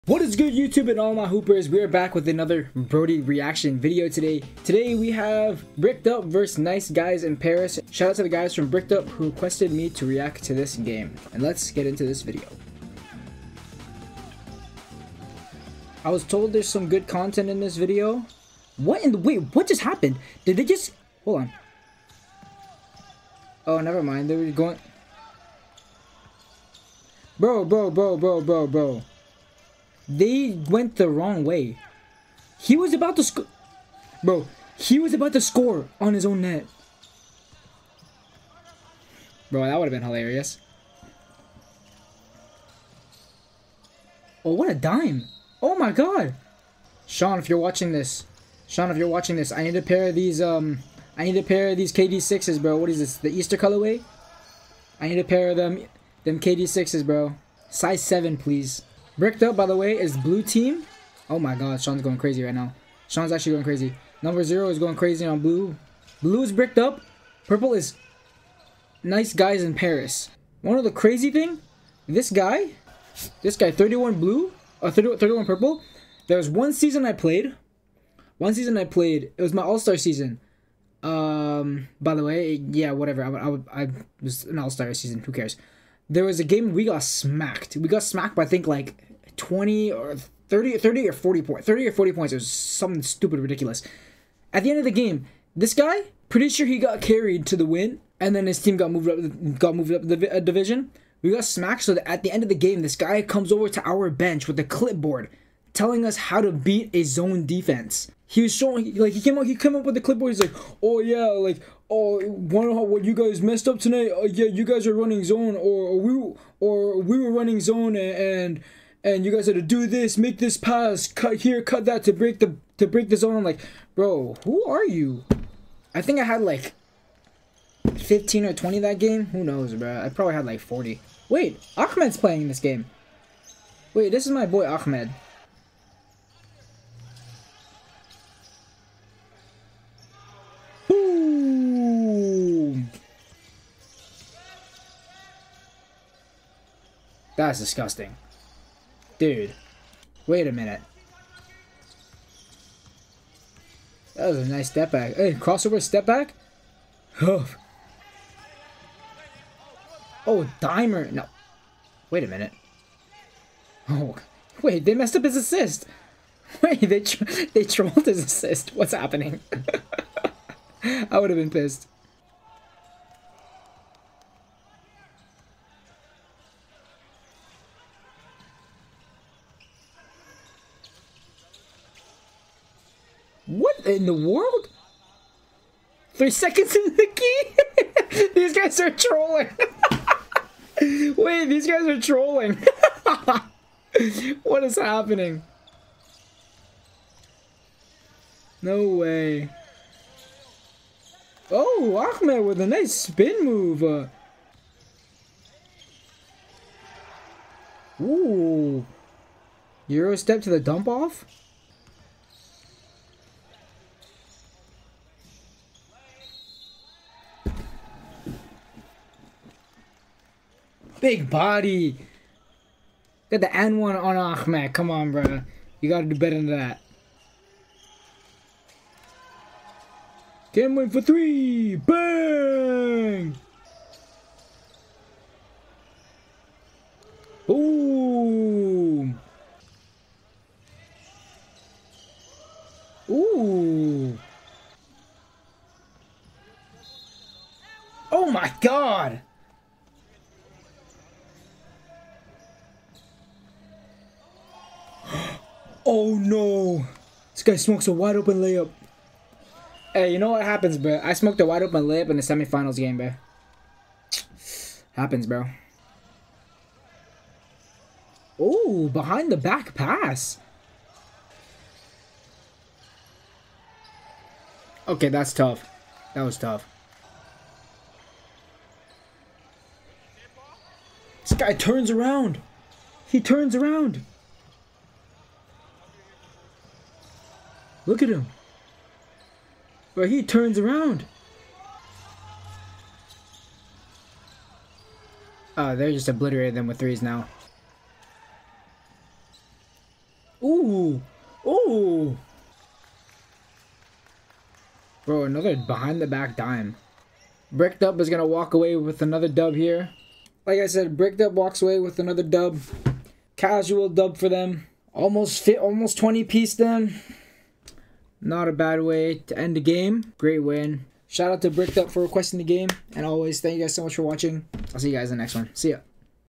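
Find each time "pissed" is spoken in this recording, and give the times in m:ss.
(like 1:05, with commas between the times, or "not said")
2:51.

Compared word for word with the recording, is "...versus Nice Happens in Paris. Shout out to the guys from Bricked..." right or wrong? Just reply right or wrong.
wrong.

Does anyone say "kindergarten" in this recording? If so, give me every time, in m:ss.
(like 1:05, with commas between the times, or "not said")
not said.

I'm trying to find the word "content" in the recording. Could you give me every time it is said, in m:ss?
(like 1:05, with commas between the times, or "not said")
0:17.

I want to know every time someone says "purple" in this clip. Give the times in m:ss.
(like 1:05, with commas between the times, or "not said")
1:07, 1:15.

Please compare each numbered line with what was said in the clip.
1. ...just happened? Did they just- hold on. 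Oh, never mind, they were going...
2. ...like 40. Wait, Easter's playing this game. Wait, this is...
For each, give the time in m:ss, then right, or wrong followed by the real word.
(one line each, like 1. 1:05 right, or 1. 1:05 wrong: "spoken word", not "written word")
1. 0:19 right
2. 2:10 wrong: "Ahmed", not "Easter".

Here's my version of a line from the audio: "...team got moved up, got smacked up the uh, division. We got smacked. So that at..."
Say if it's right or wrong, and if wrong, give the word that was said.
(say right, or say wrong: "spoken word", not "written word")
wrong: "moved", not "smacked".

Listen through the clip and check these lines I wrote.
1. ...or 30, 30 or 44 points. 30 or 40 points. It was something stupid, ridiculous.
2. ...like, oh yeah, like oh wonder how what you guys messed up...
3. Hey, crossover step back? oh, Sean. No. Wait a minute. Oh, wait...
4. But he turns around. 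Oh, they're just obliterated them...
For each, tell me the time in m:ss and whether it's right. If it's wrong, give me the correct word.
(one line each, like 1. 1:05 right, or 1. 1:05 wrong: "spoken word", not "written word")
1. 1:29 wrong: "40", not "44"
2. 1:50 right
3. 2:35 wrong: "Dimer", not "Sean"
4. 4:49 right.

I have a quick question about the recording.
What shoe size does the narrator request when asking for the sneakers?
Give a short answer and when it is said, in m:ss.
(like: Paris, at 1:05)
7, at 0:57.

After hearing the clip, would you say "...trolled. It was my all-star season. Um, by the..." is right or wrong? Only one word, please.
wrong.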